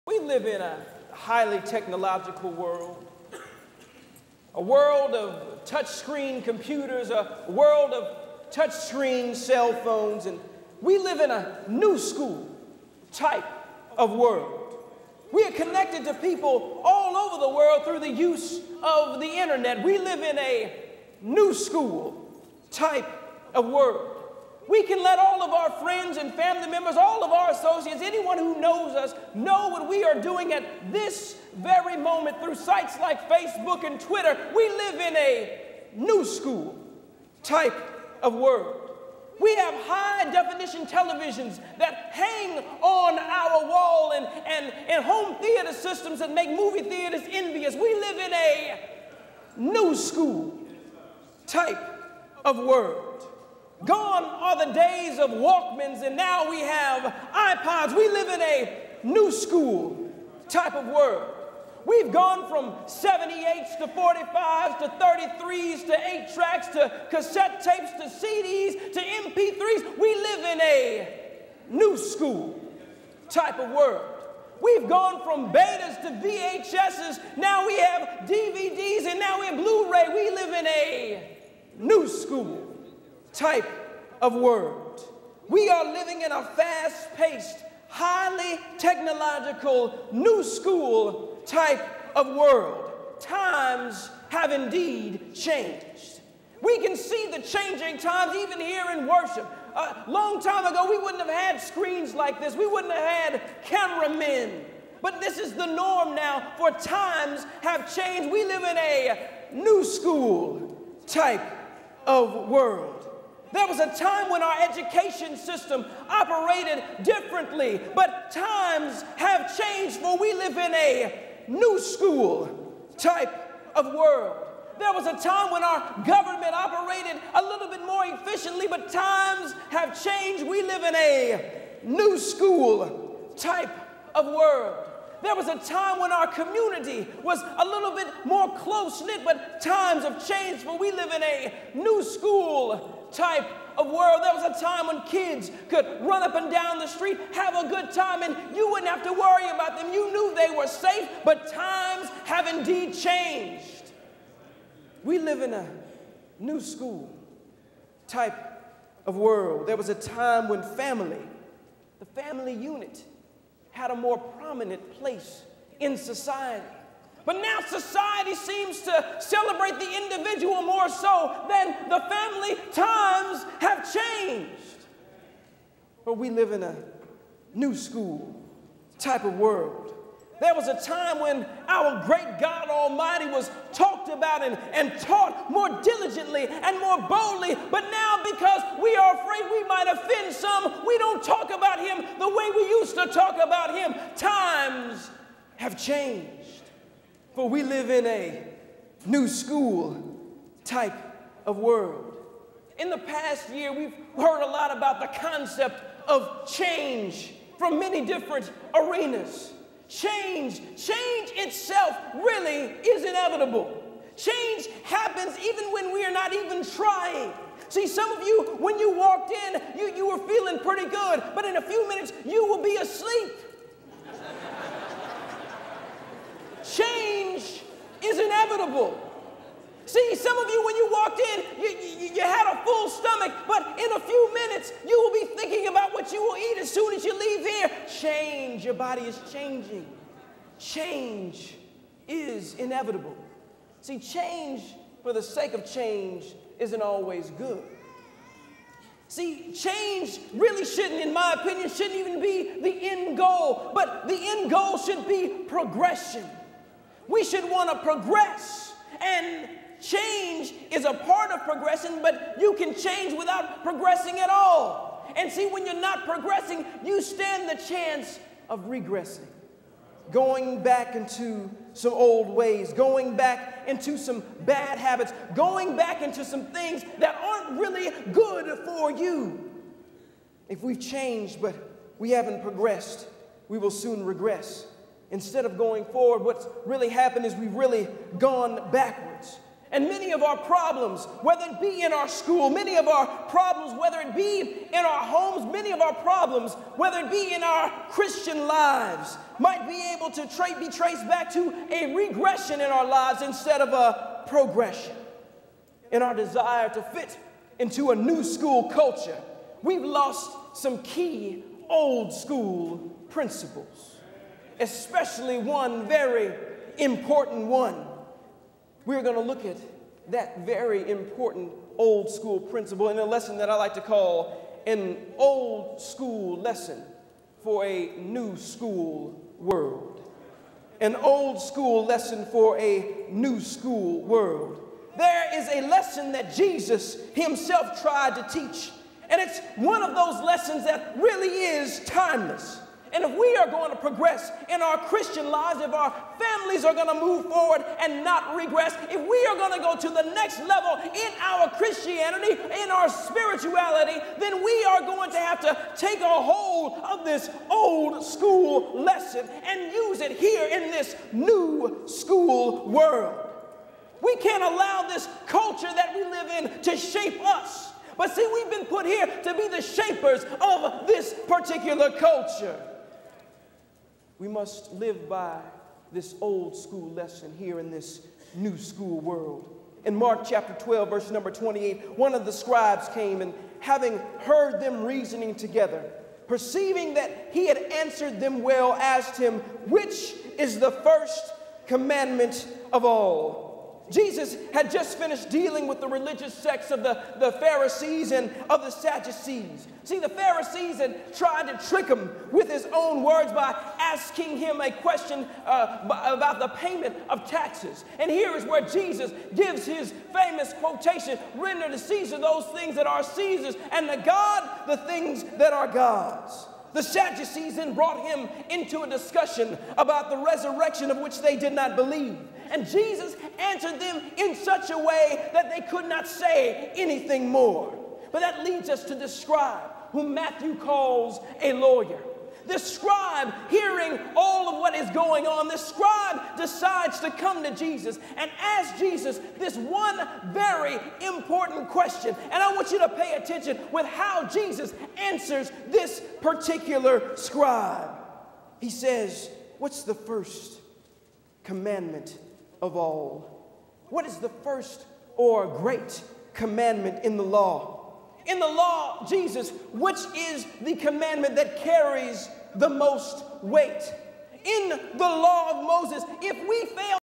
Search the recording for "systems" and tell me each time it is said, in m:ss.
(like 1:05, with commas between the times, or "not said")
0:45, 1:55.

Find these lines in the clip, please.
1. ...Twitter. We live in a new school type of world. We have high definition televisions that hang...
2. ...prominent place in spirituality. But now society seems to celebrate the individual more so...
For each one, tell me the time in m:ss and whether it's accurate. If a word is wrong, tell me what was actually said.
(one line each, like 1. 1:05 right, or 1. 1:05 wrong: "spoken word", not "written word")
1. 0:33 right
2. 2:44 wrong: "society", not "spirituality".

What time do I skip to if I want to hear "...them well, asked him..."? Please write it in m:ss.
6:28.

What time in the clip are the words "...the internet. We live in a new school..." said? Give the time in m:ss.
0:19.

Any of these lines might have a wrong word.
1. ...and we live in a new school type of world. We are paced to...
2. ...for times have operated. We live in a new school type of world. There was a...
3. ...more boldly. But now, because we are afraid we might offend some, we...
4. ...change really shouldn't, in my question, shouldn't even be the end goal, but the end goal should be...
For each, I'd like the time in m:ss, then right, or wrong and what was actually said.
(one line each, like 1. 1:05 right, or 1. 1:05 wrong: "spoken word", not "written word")
1. 0:10 wrong: "connected", not "paced"
2. 1:46 wrong: "changed", not "operated"
3. 3:06 right
4. 4:09 wrong: "opinion", not "question".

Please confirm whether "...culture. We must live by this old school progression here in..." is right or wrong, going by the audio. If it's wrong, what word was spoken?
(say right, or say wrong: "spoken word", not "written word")
wrong: "lesson", not "progression".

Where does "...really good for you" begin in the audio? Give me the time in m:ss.
4:37.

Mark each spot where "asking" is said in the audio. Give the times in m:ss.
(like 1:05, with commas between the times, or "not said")
6:43.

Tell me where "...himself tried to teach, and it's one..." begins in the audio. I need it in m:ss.
5:37.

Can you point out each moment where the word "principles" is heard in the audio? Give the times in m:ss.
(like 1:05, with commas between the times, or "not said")
5:13, 5:22.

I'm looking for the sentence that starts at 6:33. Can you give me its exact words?
Jesus had just finished dealing with the religious sects of the, the Pharisees and of the Sadducees.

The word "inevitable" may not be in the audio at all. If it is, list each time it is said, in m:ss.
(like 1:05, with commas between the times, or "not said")
3:33, 3:48, 4:02.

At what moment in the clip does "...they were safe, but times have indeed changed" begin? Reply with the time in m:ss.
2:30.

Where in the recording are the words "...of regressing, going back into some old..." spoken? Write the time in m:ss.
4:28.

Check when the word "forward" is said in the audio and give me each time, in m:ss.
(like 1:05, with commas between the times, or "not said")
4:45, 5:47.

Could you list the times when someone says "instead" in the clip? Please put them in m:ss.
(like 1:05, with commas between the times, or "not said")
4:45, 5:03.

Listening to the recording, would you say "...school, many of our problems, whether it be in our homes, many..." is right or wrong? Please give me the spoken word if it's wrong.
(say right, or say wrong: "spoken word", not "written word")
right.